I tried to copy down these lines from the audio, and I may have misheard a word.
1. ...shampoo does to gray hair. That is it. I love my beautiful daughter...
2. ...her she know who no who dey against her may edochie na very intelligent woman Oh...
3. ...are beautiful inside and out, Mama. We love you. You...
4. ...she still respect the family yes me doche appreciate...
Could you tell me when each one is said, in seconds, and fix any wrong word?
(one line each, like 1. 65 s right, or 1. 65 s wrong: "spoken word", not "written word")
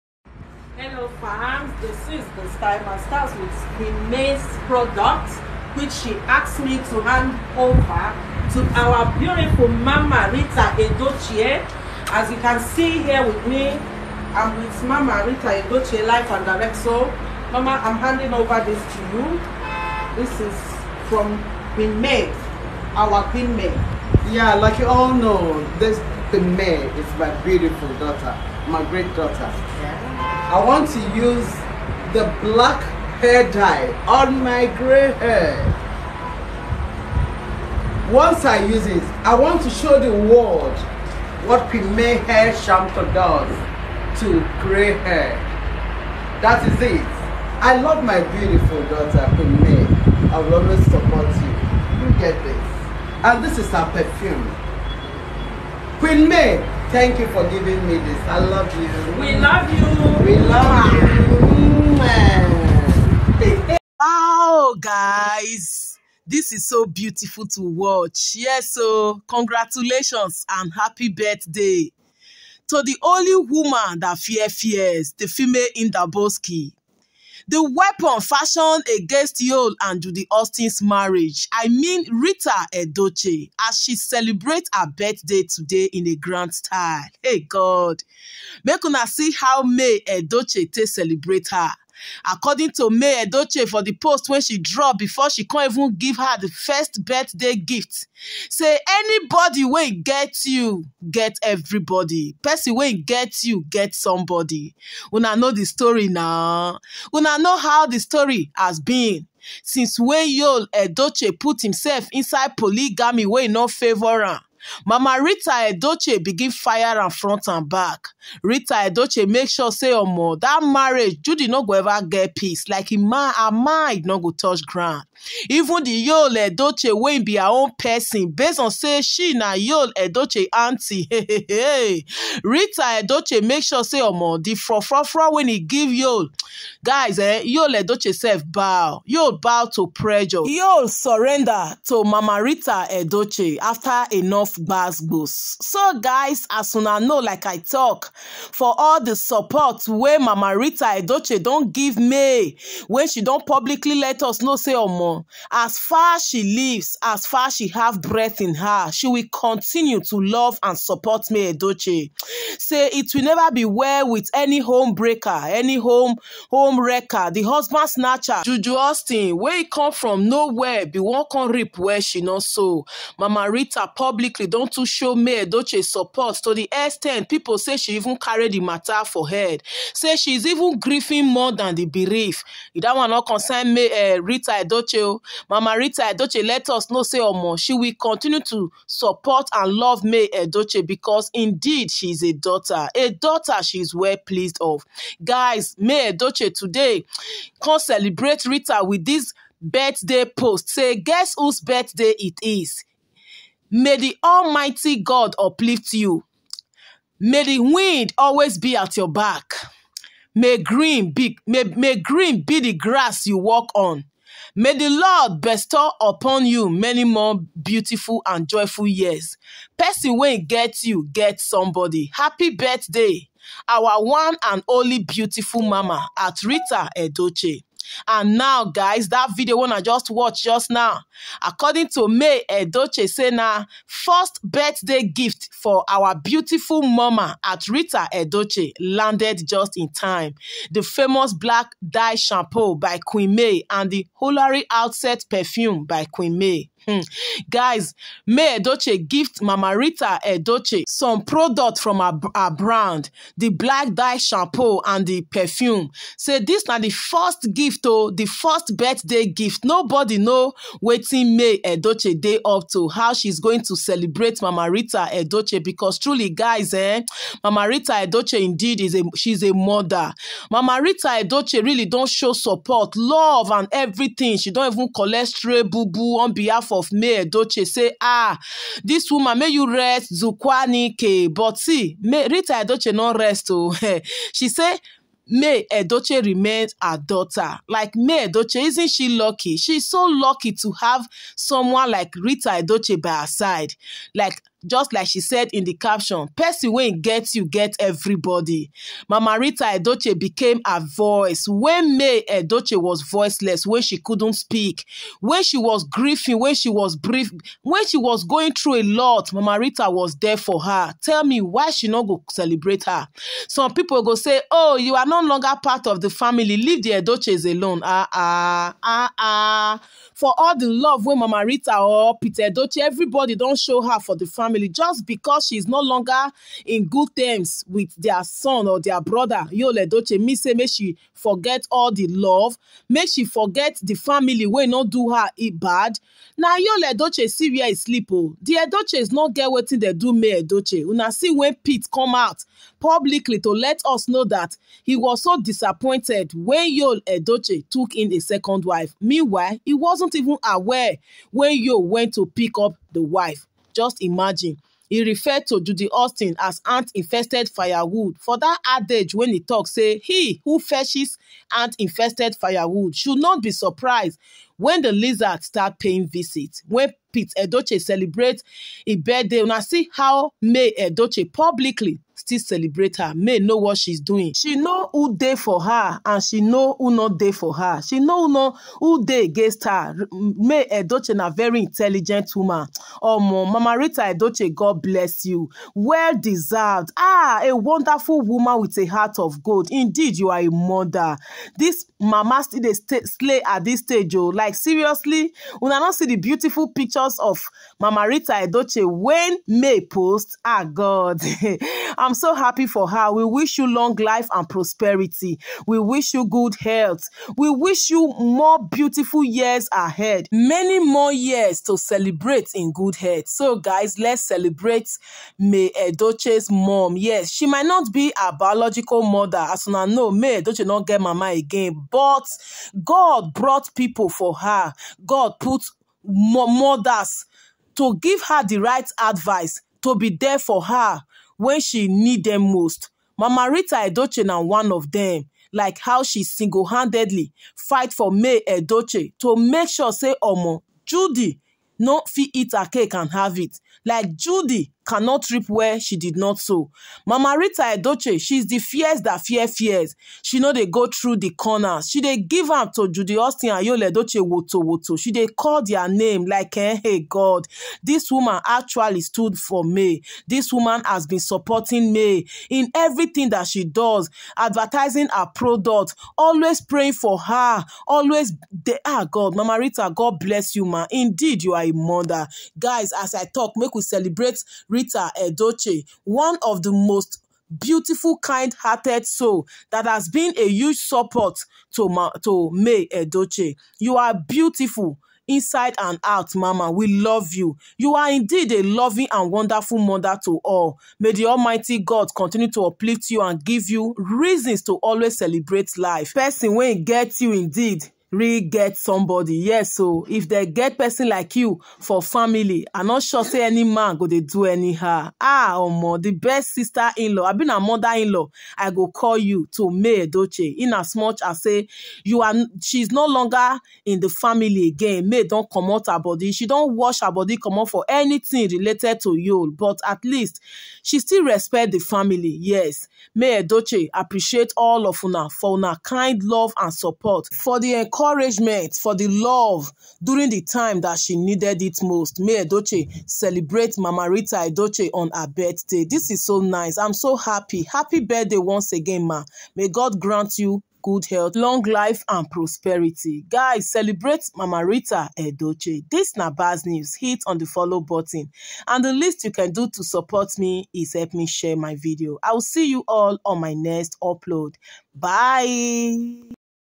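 1. 42 s right
2. 377 s right
3. 483 s right
4. 520 s right.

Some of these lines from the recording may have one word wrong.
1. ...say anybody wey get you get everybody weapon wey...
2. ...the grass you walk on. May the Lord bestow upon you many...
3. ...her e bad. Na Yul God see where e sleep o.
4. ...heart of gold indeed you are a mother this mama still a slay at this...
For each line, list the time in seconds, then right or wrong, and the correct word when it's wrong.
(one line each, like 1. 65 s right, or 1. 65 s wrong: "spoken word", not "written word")
1. 98 s wrong: "person", not "weapon"
2. 212 s right
3. 335 s wrong: "Edochie", not "God"
4. 388 s right.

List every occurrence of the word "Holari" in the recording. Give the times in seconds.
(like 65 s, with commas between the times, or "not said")
244 s.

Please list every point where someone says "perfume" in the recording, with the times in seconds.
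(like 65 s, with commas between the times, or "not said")
53 s, 245 s, 255 s.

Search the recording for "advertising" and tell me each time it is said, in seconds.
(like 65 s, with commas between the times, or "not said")
464 s.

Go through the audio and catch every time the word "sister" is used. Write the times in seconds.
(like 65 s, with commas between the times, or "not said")
506 s.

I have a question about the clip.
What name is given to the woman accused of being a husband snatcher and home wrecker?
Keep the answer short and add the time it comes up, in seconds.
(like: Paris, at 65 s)
Juju Austin, at 168 s.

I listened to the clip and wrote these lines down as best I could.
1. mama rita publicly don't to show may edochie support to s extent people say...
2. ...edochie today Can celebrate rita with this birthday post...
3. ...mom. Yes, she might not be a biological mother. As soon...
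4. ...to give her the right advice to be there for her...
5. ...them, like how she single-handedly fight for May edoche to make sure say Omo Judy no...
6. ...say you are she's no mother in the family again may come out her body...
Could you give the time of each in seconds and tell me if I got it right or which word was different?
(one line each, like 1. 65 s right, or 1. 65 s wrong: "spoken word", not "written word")
1. 173 s right
2. 196 s right
3. 416 s right
4. 427 s right
5. 434 s right
6. 511 s wrong: "longer", not "mother".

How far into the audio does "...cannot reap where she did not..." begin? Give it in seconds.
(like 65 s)
444 s.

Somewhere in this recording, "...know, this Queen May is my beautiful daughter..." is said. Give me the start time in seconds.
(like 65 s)
25 s.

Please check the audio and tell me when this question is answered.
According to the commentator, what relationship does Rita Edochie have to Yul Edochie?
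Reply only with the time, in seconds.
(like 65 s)
130 s.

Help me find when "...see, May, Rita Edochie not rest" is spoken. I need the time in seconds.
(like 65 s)
281 s.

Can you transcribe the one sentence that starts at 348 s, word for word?
Meanwhile, he wasn't even aware when yo went to pick up the wife.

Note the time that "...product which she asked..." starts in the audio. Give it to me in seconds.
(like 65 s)
4 s.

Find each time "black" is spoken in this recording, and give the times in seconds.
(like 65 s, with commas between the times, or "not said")
32 s, 241 s, 253 s.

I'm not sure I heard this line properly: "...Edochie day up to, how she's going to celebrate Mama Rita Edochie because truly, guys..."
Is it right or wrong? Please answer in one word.
right.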